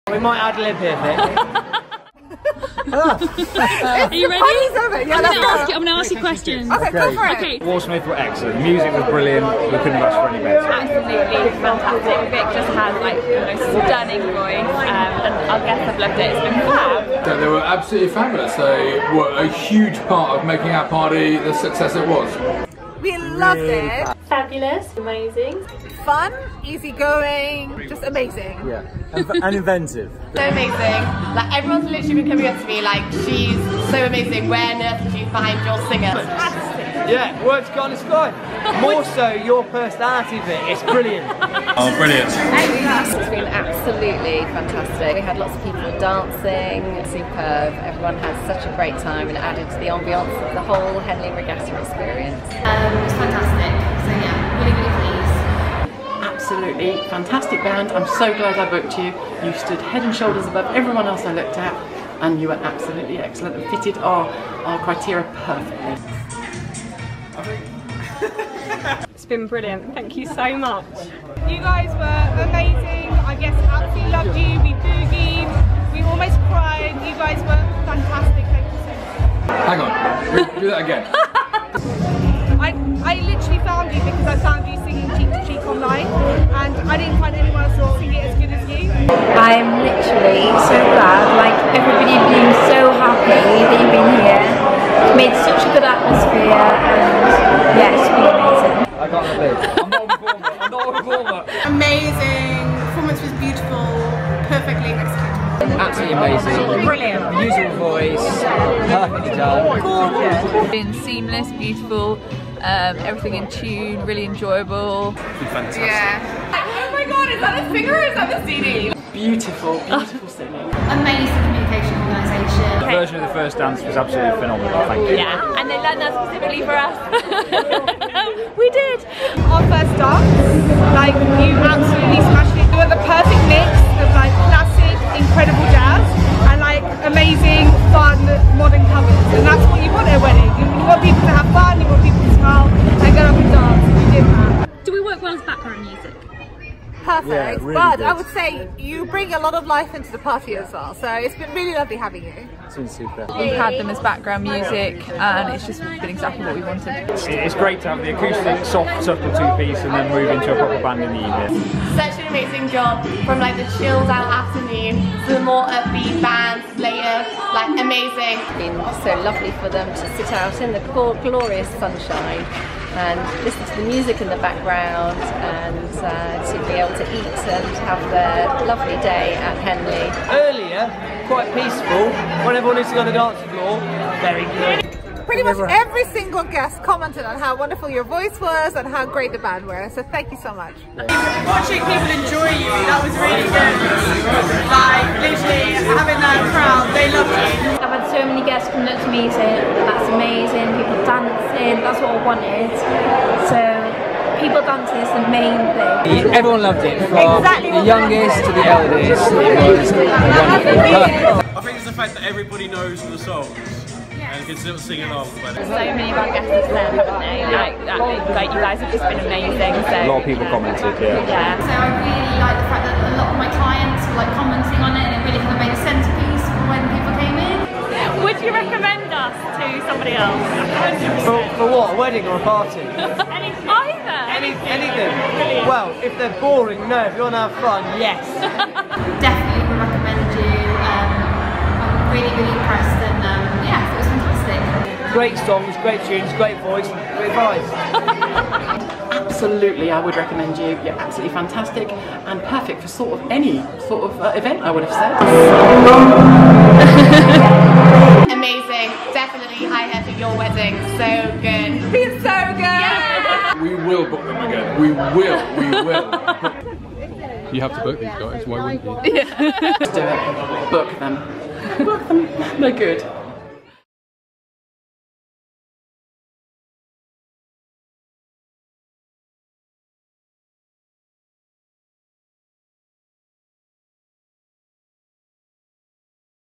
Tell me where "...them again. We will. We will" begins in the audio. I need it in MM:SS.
04:24.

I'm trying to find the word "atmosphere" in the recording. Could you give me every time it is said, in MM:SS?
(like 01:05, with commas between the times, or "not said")
01:35.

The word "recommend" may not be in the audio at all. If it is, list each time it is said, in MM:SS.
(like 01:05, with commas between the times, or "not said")
03:59, 04:10.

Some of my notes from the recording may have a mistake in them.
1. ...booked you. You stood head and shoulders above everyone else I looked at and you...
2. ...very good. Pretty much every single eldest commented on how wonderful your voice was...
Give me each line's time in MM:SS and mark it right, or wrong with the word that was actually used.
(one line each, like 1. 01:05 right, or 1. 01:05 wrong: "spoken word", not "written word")
1. 00:58 right
2. 03:04 wrong: "guest", not "eldest".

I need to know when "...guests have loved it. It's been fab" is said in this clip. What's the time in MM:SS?
00:15.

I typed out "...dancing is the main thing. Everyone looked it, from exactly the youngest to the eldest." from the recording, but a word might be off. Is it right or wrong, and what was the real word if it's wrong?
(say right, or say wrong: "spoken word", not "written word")
wrong: "loved", not "looked".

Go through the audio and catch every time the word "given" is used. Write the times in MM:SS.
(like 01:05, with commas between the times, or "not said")
not said.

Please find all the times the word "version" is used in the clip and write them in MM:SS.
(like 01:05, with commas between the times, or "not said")
02:02.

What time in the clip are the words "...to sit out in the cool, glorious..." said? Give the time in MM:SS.
02:49.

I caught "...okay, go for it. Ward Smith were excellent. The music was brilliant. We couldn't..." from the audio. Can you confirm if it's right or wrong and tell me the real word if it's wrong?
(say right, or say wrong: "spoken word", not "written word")
right.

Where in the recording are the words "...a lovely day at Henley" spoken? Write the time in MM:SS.
02:58.